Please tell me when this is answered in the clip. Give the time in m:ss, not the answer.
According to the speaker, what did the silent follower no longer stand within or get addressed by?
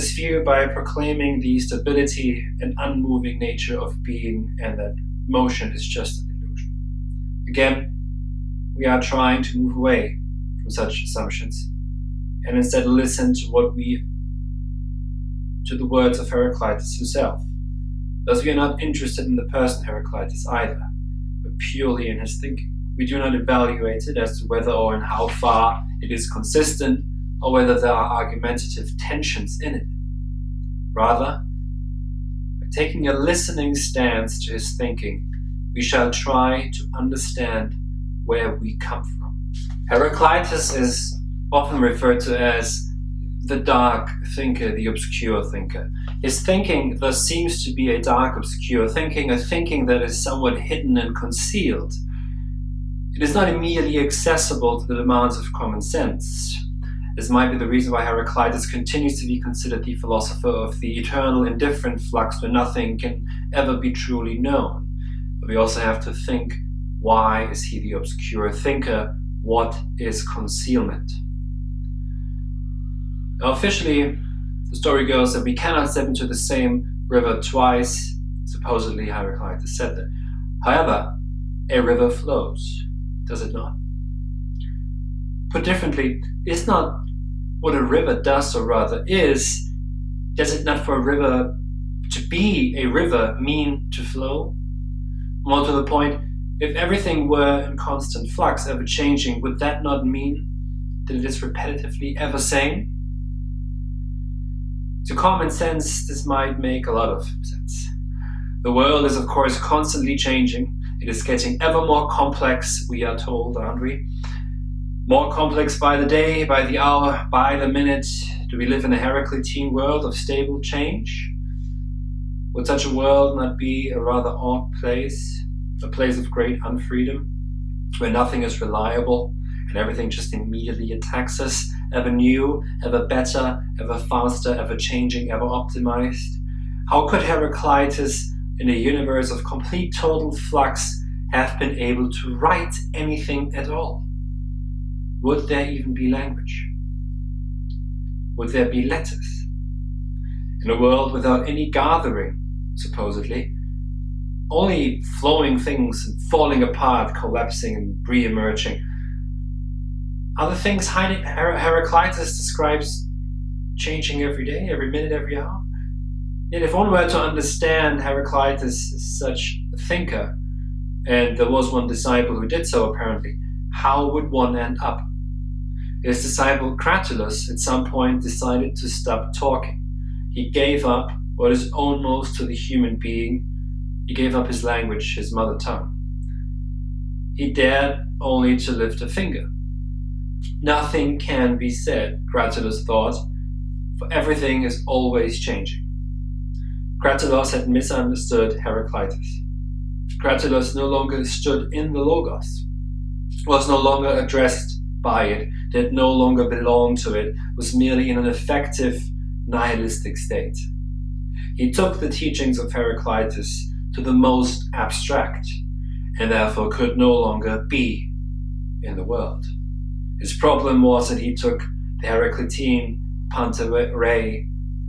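3:21.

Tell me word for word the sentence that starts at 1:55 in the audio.
More complex by the day, by the hour, by the minute?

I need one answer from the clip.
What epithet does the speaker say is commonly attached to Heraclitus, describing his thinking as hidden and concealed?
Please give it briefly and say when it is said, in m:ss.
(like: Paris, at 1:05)
the dark thinker, at 0:43.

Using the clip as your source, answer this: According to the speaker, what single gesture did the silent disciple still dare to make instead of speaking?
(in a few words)
lift a finger.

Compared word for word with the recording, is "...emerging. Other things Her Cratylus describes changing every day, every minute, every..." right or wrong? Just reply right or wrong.
wrong.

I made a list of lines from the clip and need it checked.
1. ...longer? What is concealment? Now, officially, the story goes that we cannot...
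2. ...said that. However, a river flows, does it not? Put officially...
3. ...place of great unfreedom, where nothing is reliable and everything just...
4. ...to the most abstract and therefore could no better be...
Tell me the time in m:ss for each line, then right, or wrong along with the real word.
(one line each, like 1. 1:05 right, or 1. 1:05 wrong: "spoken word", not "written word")
1. 1:08 wrong: "thinker", not "longer"
2. 1:19 wrong: "differently", not "officially"
3. 2:05 right
4. 3:33 wrong: "longer", not "better".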